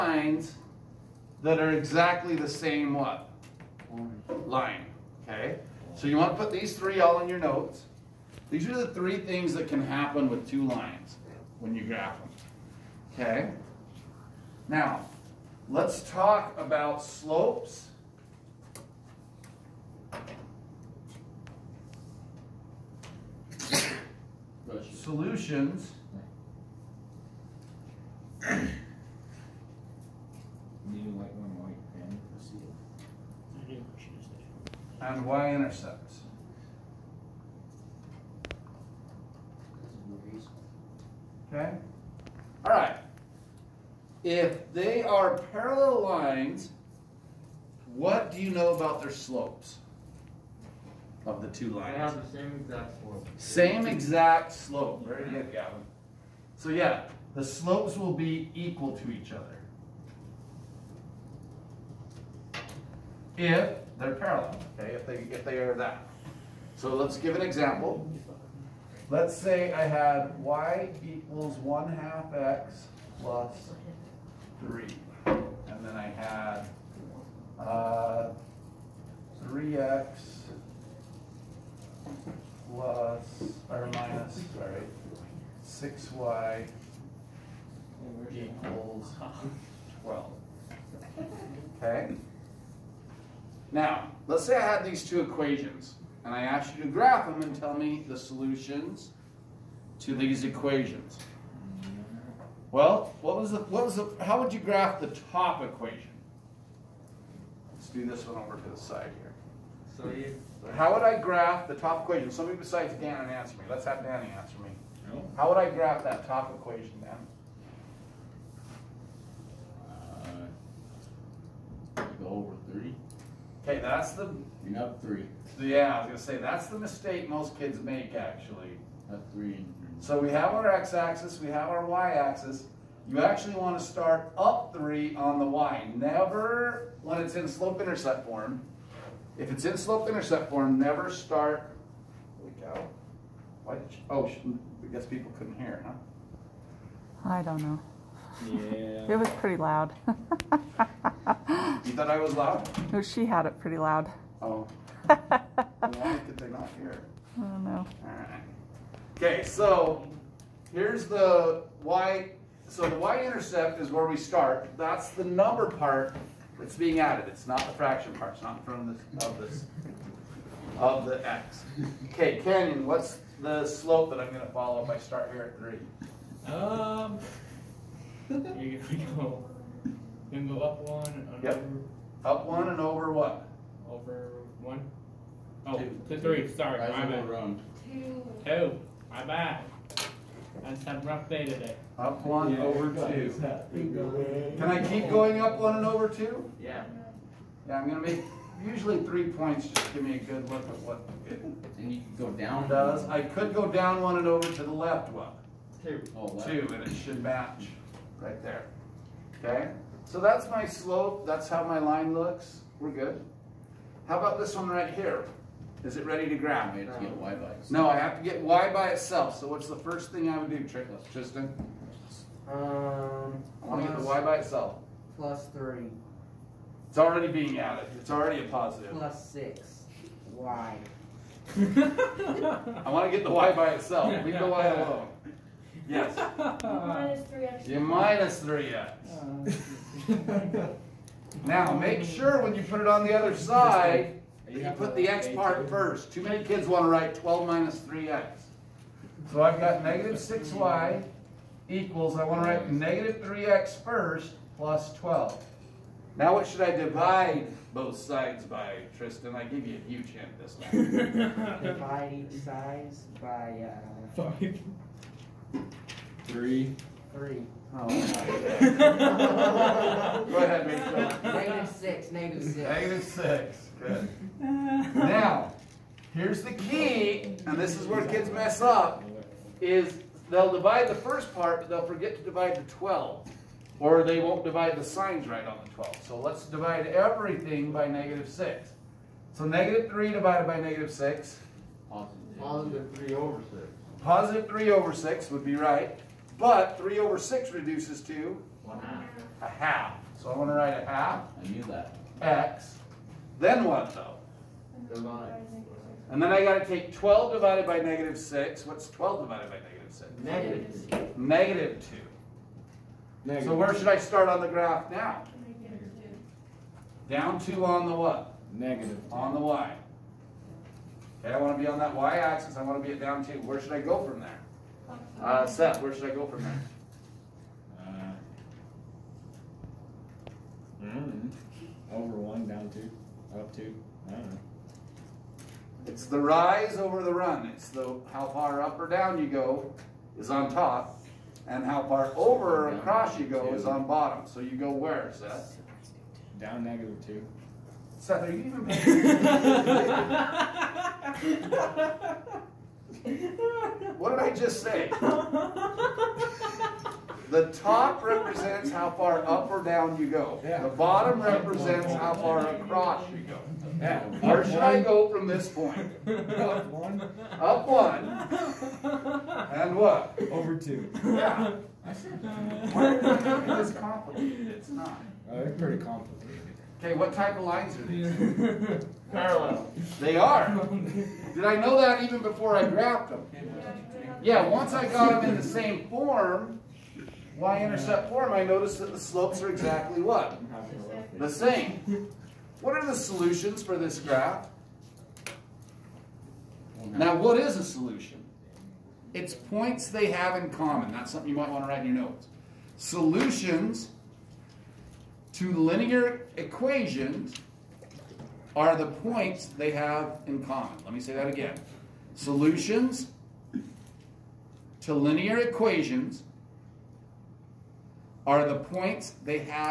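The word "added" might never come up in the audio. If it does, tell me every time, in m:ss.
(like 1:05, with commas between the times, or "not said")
2:46, 3:47.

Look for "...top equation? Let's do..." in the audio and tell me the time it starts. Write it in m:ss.
1:45.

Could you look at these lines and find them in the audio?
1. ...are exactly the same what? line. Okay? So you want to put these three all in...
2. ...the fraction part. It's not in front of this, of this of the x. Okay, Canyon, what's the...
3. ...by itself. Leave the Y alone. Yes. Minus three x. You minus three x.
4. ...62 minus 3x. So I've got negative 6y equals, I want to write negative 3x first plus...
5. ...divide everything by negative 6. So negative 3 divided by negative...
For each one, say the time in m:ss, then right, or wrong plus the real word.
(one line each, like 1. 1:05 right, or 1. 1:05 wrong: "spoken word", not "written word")
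1. 0:01 right
2. 2:47 right
3. 3:53 right
4. 4:07 wrong: "12", not "62"
5. 4:46 right.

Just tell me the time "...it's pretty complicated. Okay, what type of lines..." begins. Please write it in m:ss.
6:15.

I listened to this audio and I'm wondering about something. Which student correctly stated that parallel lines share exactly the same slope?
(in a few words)
Gavin.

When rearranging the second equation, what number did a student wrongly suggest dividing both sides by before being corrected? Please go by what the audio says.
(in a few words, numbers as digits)
5.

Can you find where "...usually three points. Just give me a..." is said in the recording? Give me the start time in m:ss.
3:18.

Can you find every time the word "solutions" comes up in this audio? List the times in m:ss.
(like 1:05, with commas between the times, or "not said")
0:24, 1:38, 6:32, 6:37, 6:42, 6:52.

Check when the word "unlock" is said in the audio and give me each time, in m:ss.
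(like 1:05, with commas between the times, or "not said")
not said.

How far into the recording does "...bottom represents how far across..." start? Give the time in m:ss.
6:00.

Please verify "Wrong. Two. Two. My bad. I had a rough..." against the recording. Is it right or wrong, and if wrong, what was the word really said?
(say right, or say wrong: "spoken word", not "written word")
right.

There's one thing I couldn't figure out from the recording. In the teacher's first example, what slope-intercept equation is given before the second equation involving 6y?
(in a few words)
y = 1/2x + 3.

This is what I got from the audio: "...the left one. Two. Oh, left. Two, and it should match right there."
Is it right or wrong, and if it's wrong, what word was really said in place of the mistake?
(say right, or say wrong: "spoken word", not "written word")
right.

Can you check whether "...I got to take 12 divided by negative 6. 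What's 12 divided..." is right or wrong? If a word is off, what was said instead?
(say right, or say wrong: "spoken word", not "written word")
right.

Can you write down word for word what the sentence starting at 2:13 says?
You actually want to start up three on the y.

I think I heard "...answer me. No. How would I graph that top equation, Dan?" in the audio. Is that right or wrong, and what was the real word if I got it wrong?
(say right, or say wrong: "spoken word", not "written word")
right.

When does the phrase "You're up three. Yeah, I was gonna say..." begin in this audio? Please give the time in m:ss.
2:04.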